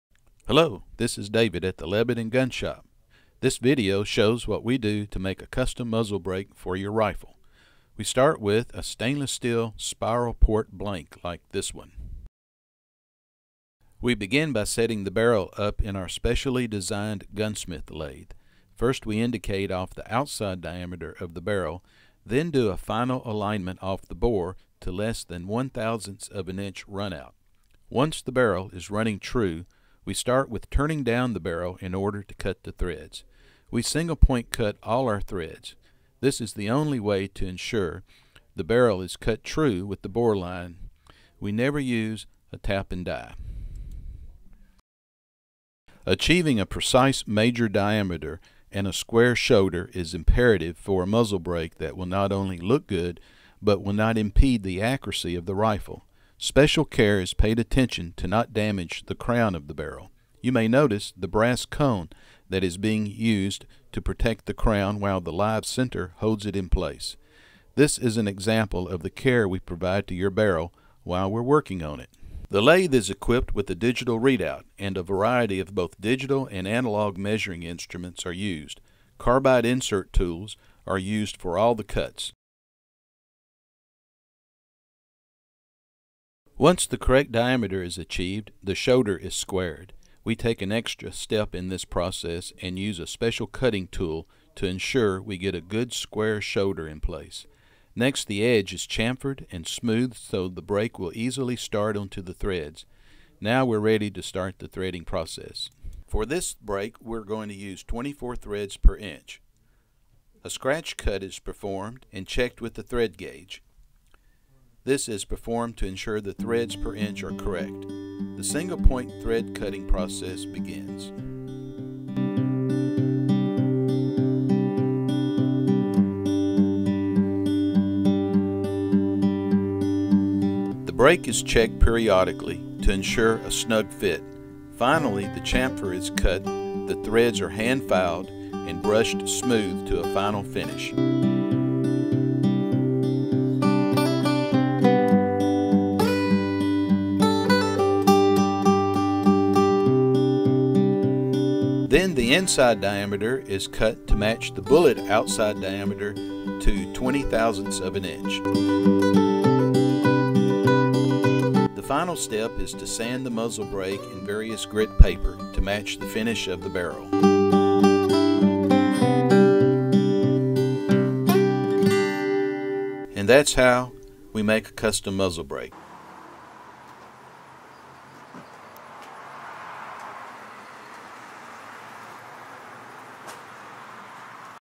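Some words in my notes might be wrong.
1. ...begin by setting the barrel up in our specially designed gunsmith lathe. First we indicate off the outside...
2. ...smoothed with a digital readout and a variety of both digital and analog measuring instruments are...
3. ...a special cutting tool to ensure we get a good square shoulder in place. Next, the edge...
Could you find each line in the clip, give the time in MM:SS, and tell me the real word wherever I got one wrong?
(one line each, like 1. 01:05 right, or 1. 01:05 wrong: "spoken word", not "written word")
1. 00:14 right
2. 01:13 wrong: "equipped", not "smoothed"
3. 01:32 right.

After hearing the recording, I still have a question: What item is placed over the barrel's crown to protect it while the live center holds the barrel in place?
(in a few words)
brass cone.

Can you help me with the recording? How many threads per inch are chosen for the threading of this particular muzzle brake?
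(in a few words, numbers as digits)
24.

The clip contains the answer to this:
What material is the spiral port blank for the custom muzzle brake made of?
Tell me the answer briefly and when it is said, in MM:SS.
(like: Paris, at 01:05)
stainless steel, at 00:08.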